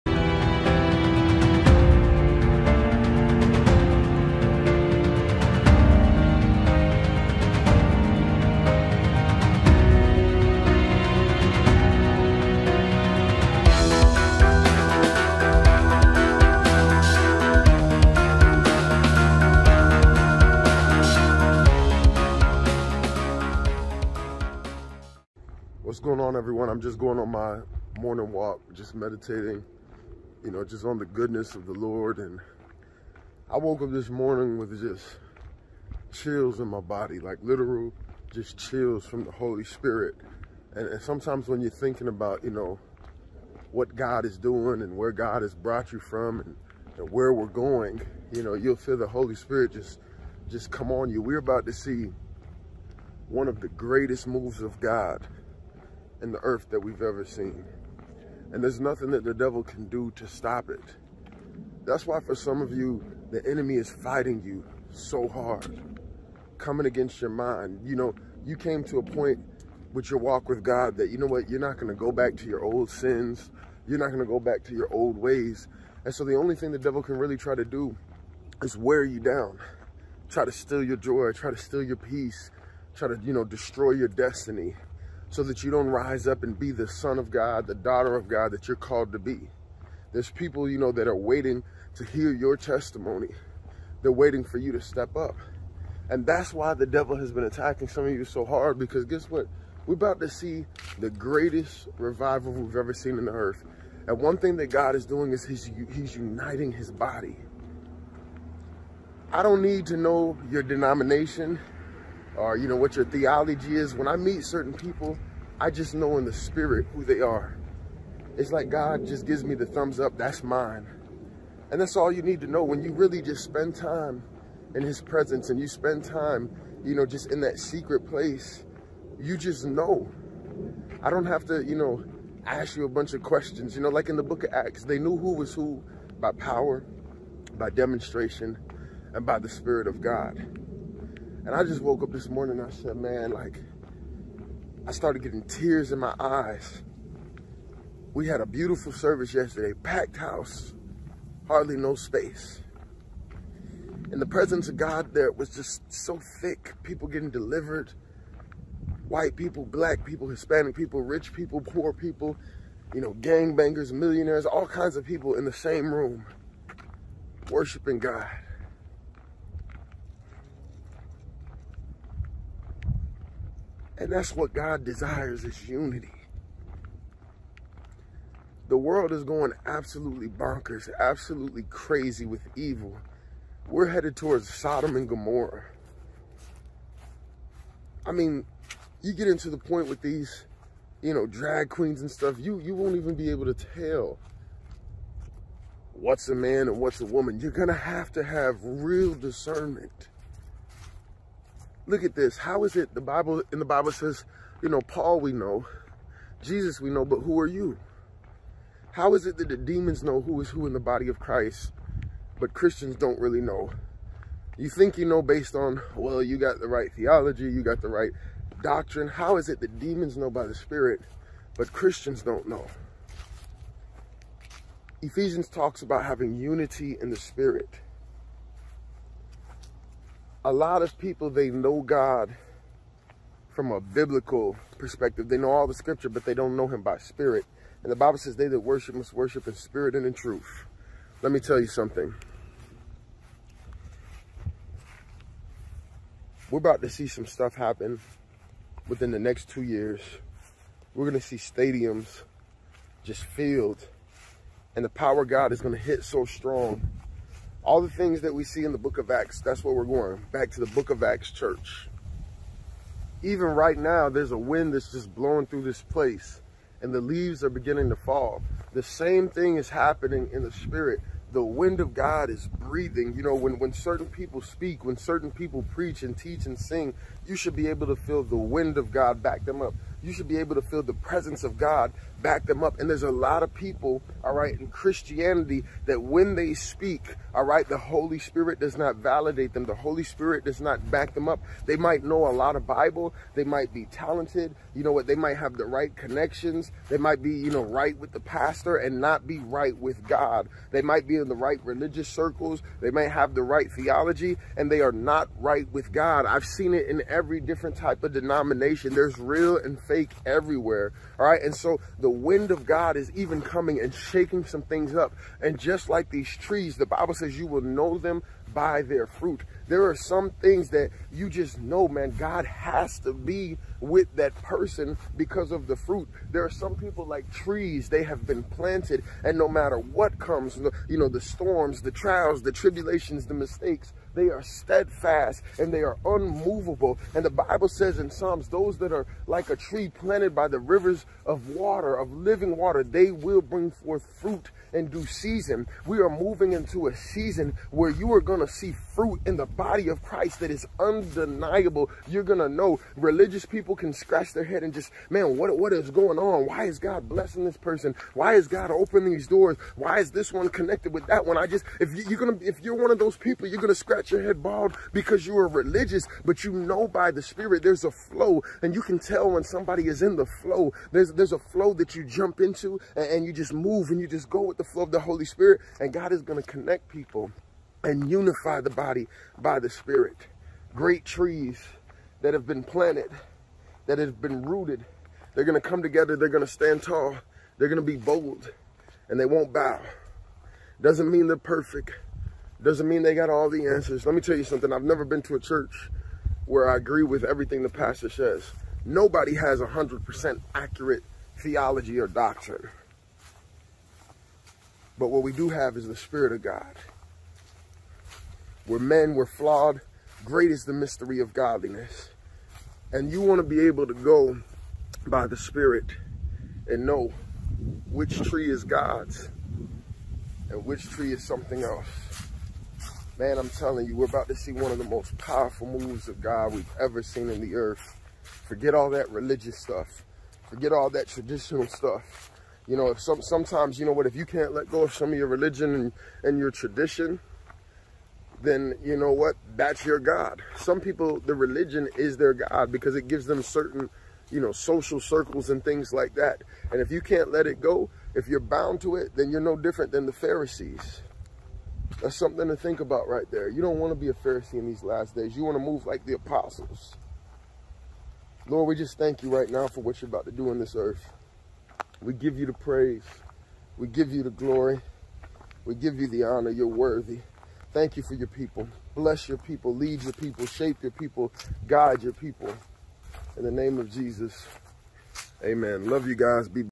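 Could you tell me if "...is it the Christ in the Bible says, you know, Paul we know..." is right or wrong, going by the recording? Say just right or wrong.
wrong.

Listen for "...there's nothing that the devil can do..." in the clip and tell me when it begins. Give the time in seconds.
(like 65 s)
58 s.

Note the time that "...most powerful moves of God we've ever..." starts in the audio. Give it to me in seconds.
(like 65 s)
424 s.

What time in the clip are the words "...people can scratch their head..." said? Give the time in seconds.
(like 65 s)
353 s.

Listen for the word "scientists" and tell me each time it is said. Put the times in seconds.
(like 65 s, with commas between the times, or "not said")
not said.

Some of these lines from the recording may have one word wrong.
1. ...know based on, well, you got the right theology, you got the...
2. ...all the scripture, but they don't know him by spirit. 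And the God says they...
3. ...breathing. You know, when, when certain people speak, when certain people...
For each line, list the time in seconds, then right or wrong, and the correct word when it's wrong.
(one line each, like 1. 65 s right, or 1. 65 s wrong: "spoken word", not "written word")
1. 215 s right
2. 235 s wrong: "Bible", not "God"
3. 272 s right.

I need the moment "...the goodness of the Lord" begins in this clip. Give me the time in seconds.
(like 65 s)
30 s.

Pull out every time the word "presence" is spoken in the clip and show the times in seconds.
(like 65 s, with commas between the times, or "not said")
125 s, 154 s, 280 s.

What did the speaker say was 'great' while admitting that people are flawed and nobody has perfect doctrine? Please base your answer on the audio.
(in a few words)
the mystery of godliness.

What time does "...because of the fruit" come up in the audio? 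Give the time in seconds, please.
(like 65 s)
325 s.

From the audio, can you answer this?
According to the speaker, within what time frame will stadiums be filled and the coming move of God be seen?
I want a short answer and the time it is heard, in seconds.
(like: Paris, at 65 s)
2 years, at 249 s.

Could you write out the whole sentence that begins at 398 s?
Nobody has 100% accurate theology or doctrine.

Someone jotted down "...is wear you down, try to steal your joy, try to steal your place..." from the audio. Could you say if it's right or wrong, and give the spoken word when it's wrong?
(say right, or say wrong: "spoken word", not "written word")
wrong: "peace", not "place".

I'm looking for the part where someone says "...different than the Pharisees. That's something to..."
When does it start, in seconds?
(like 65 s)
449 s.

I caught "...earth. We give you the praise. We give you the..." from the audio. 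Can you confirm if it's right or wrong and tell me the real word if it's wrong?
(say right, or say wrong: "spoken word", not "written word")
right.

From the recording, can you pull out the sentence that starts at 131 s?
I don't have to, you know, ask you a bunch of questions.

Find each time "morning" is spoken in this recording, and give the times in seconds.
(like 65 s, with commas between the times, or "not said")
27 s, 34 s, 142 s.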